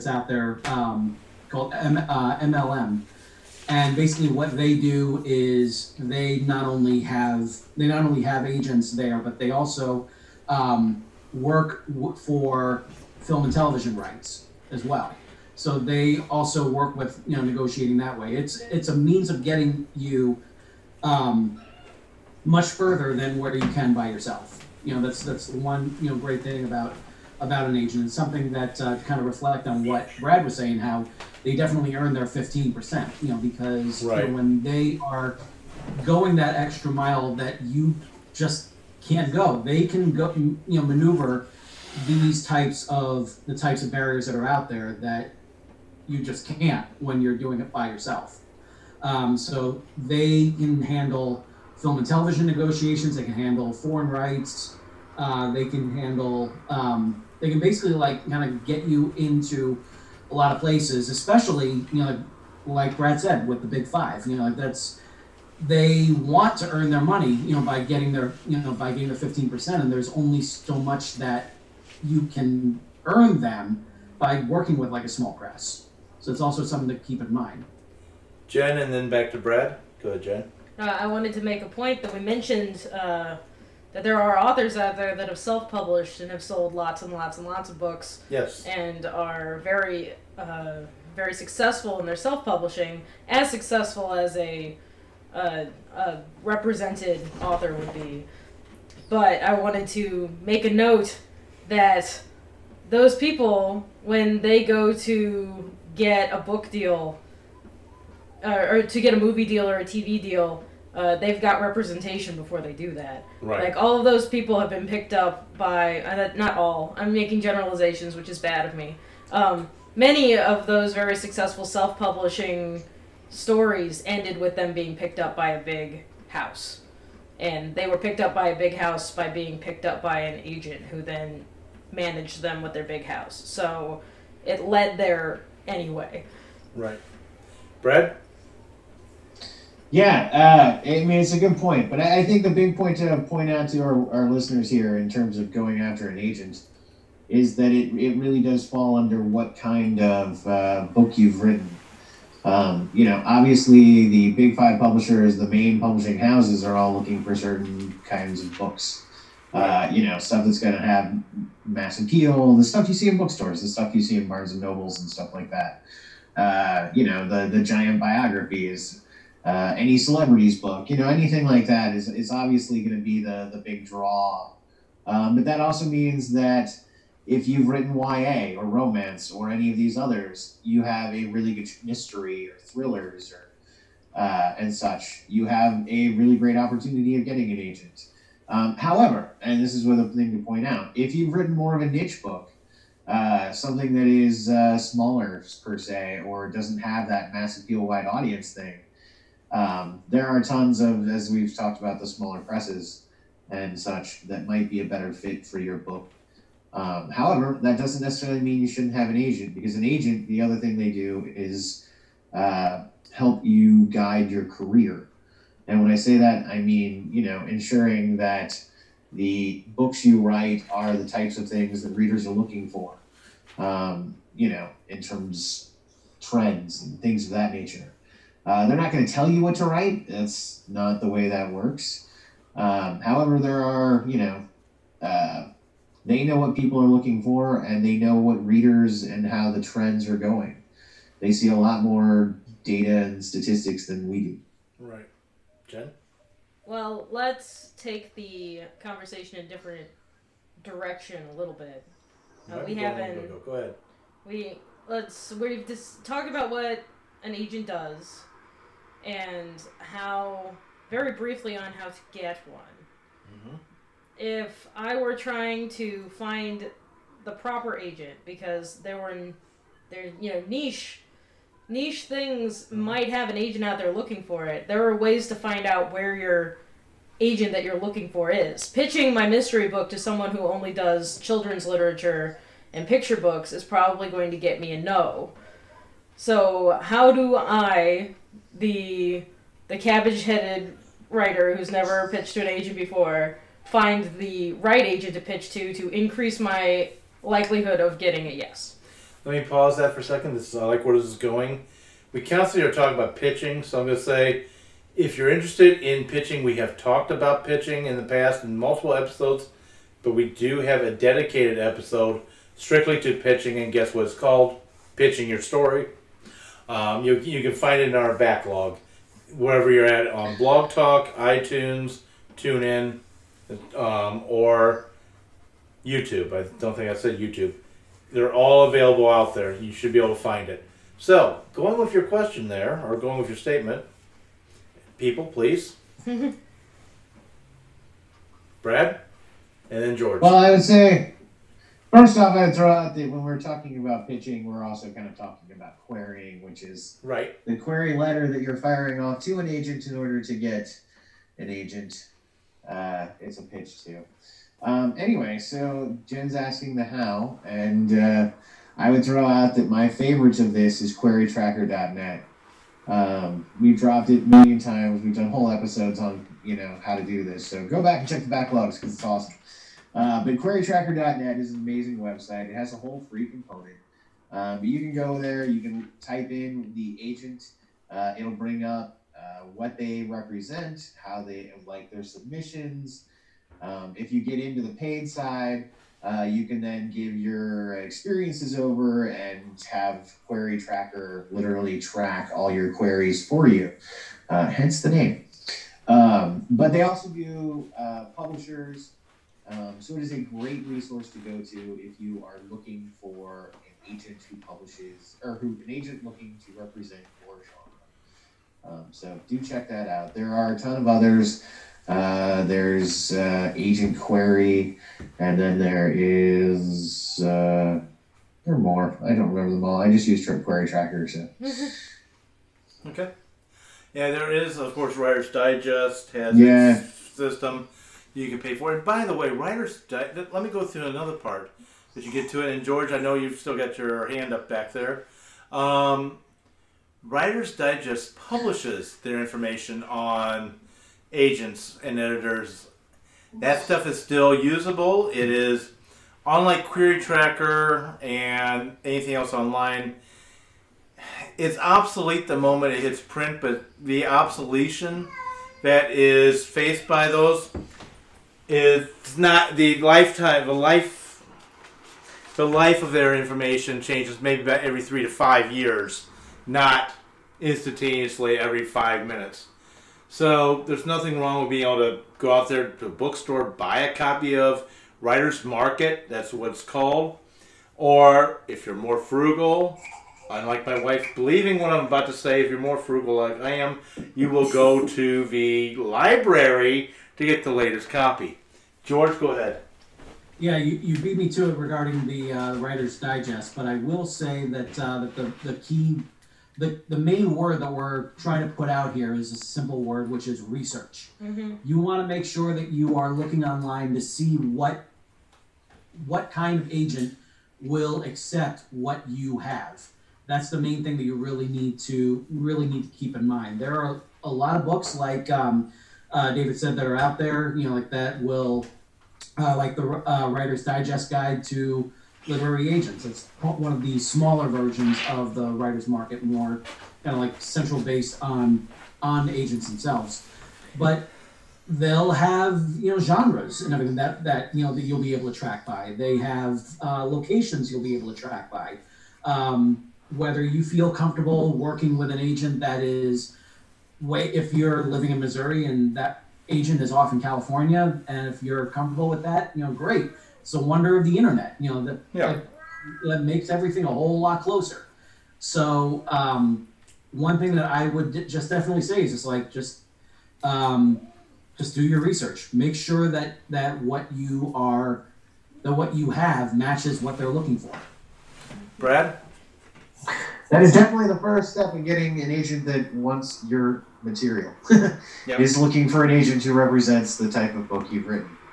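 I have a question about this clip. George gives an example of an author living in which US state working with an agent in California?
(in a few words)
Missouri.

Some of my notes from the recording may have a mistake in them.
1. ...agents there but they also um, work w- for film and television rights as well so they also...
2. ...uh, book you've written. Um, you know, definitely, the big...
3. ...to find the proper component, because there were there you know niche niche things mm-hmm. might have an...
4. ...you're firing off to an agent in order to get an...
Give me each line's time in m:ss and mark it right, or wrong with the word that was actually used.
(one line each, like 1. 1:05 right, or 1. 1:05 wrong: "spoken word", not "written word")
1. 0:08 right
2. 2:30 wrong: "obviously", not "definitely"
3. 4:25 wrong: "agent", not "component"
4. 5:48 right.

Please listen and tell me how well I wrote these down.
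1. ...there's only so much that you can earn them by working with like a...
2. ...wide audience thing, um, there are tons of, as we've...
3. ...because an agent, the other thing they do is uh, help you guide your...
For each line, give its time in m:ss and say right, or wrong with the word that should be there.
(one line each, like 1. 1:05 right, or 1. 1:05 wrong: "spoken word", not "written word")
1. 1:09 right
2. 3:17 right
3. 3:29 right.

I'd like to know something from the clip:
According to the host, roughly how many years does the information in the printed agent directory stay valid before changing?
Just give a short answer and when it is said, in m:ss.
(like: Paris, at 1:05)
3 to 5 years, at 7:44.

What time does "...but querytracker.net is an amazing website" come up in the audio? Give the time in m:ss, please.
6:10.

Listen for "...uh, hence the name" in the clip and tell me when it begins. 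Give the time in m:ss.
6:34.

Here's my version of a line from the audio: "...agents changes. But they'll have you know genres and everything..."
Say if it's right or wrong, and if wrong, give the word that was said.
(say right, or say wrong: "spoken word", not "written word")
wrong: "themselves", not "changes".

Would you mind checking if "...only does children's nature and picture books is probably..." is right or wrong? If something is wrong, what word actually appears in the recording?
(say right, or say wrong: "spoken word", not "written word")
wrong: "literature", not "nature".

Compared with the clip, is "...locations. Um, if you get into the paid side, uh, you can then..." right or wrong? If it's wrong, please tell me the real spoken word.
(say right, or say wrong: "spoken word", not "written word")
wrong: "submissions", not "locations".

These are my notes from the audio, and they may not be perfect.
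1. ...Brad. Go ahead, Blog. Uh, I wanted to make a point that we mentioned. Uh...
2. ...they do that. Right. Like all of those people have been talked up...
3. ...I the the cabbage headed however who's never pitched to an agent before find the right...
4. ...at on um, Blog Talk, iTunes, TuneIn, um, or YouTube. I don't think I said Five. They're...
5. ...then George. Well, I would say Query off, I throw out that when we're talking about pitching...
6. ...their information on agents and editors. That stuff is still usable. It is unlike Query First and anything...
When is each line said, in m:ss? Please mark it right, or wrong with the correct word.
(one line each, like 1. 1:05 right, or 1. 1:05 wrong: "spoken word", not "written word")
1. 1:19 wrong: "Jen", not "Blog"
2. 1:52 wrong: "picked", not "talked"
3. 4:47 wrong: "writer", not "however"
4. 5:19 wrong: "YouTube", not "Five"
5. 5:39 wrong: "First", not "Query"
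6. 7:18 wrong: "Tracker", not "First".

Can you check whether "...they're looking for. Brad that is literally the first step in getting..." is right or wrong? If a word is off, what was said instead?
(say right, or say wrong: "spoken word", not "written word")
wrong: "definitely", not "literally".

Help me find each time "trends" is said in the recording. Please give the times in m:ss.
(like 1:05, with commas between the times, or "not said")
3:46, 3:59.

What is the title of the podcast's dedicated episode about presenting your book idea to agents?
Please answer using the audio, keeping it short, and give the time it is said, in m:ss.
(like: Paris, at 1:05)
Pitching Your Story, at 5:14.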